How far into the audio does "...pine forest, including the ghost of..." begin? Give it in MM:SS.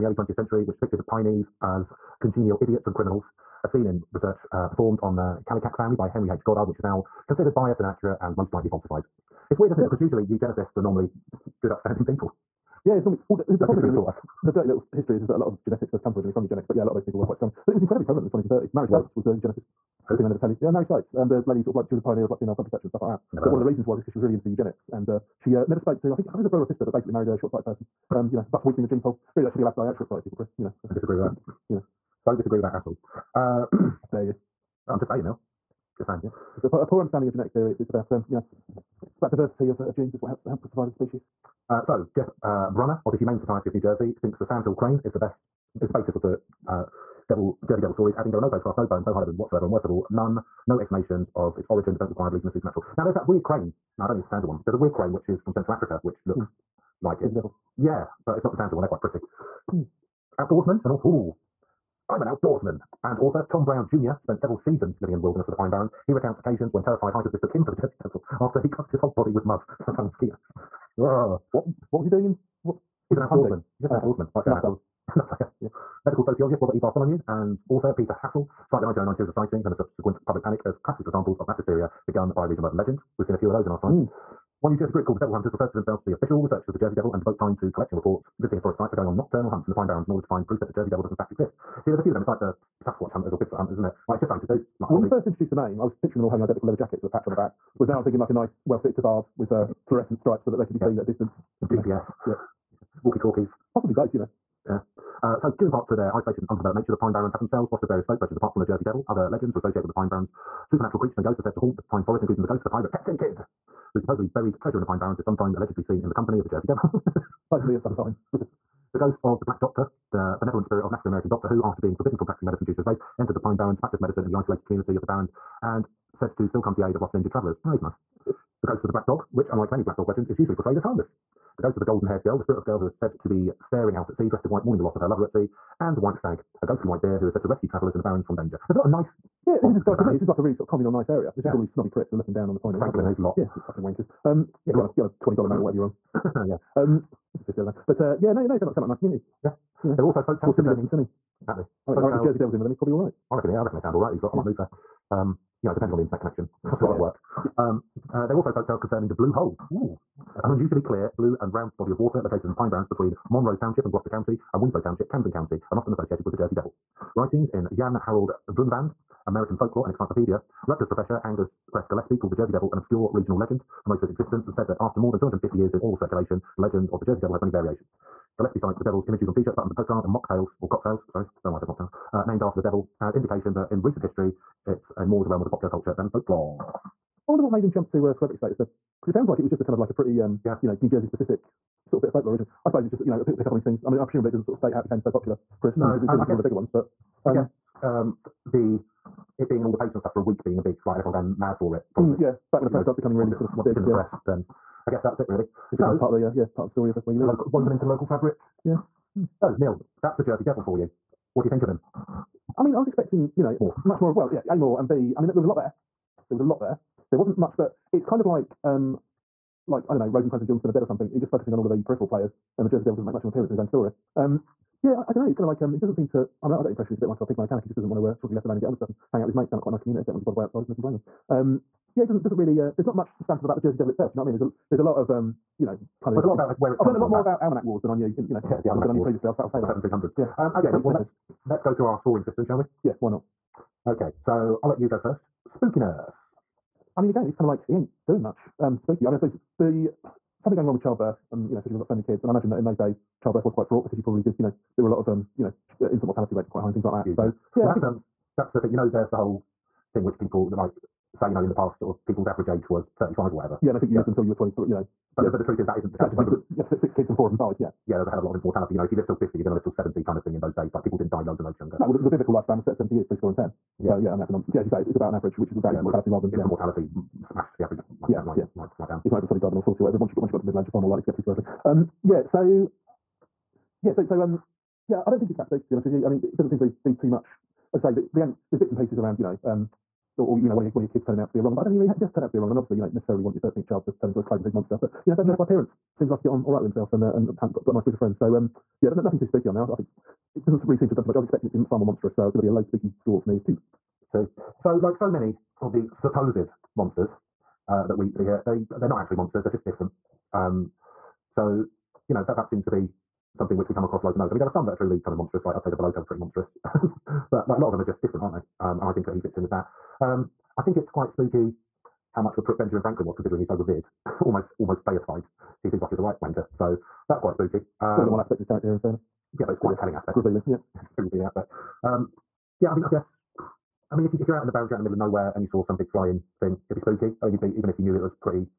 01:51.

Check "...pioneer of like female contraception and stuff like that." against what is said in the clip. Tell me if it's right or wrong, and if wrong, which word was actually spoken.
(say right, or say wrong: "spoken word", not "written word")
right.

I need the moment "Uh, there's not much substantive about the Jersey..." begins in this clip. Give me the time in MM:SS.
03:52.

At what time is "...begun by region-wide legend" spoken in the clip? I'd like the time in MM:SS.
01:22.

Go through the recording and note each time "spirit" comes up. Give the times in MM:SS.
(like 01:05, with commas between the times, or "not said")
02:00, 02:12.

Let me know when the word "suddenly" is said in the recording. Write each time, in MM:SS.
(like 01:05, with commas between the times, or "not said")
04:39.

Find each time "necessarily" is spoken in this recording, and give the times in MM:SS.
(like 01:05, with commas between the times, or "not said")
04:52.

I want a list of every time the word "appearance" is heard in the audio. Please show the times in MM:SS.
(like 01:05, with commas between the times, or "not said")
03:43, 04:55.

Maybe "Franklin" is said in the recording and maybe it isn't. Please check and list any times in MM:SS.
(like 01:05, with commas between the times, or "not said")
02:22, 05:22.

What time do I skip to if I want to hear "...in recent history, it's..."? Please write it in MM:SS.
03:03.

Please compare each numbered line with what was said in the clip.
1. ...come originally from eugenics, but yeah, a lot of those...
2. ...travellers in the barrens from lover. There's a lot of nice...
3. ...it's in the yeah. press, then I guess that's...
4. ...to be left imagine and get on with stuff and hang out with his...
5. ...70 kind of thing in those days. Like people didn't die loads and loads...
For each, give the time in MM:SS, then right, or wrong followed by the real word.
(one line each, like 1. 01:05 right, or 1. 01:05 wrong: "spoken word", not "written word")
1. 00:16 right
2. 02:17 wrong: "danger", not "lover"
3. 03:23 right
4. 03:48 wrong: "alone", not "imagine"
5. 04:29 right.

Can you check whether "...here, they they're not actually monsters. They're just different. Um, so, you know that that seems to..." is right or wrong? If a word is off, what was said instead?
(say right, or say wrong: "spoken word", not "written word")
right.